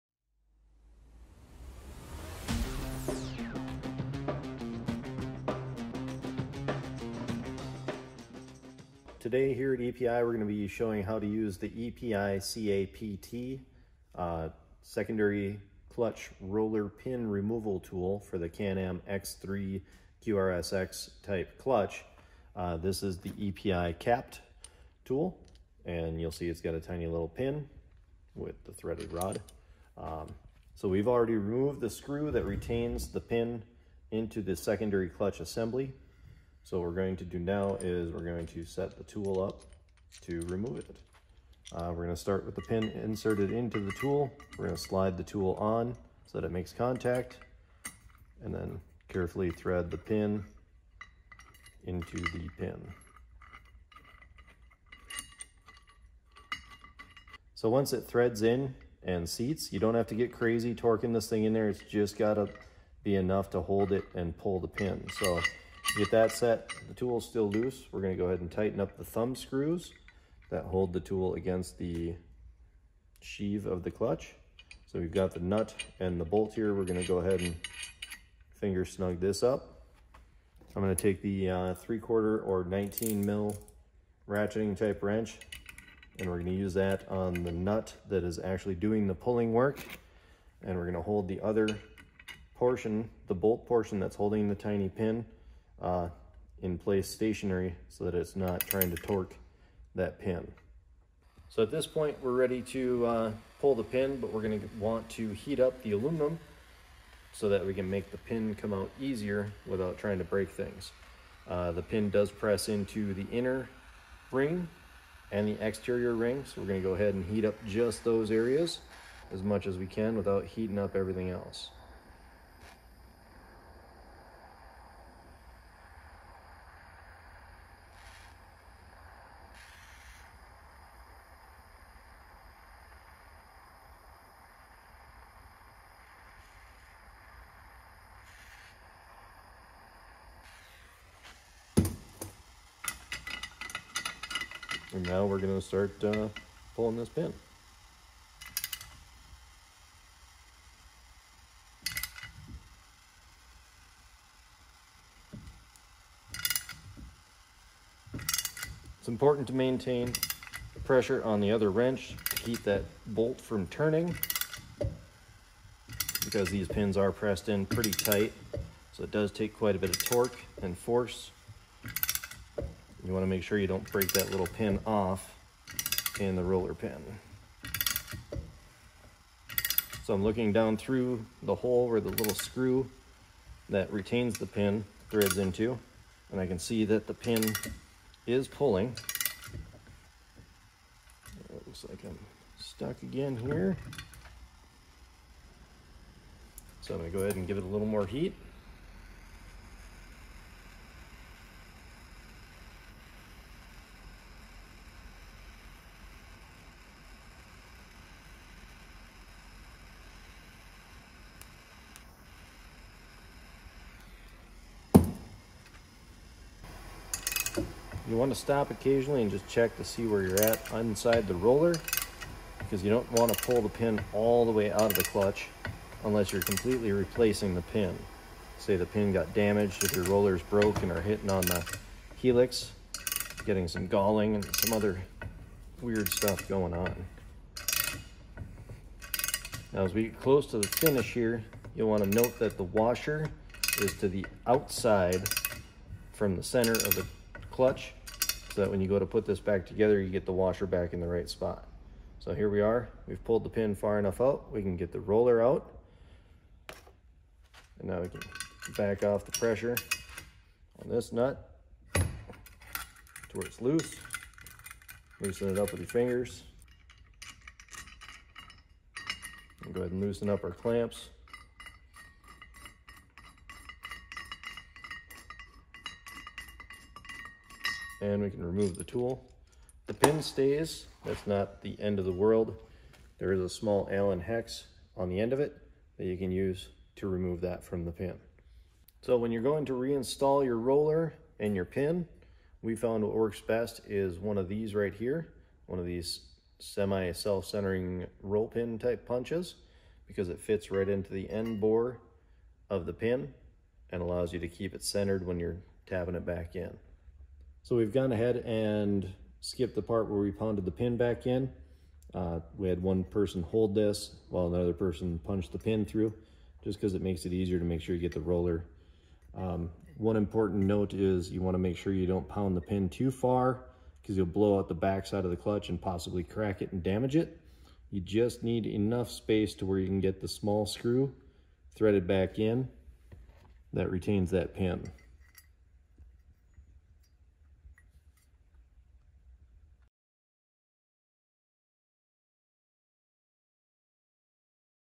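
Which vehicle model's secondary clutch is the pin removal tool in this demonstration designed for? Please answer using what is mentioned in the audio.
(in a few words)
Can-Am X3.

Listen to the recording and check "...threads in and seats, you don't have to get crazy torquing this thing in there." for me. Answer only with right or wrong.
right.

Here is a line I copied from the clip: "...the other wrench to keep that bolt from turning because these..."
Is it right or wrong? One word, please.
right.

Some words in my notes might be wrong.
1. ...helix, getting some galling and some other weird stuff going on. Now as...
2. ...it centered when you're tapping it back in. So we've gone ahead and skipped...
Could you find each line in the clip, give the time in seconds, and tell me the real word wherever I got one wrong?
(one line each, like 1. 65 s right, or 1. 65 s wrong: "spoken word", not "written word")
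1. 232 s right
2. 304 s right.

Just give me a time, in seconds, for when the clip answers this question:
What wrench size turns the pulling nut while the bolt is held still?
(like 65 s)
81 s.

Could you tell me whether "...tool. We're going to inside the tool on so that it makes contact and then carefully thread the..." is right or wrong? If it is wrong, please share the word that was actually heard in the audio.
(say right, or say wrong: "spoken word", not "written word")
wrong: "slide", not "inside".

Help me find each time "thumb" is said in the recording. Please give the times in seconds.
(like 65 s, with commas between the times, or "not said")
69 s.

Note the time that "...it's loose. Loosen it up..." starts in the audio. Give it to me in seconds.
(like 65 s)
263 s.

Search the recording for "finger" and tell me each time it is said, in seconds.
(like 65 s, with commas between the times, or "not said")
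78 s, 265 s.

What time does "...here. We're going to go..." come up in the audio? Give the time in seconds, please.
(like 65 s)
76 s.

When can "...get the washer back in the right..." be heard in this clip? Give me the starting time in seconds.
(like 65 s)
250 s.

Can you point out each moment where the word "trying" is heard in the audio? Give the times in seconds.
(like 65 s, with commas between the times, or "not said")
98 s, 109 s.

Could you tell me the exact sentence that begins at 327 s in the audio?
You just need enough space to where you can get the small screw threaded back in that retains that pin.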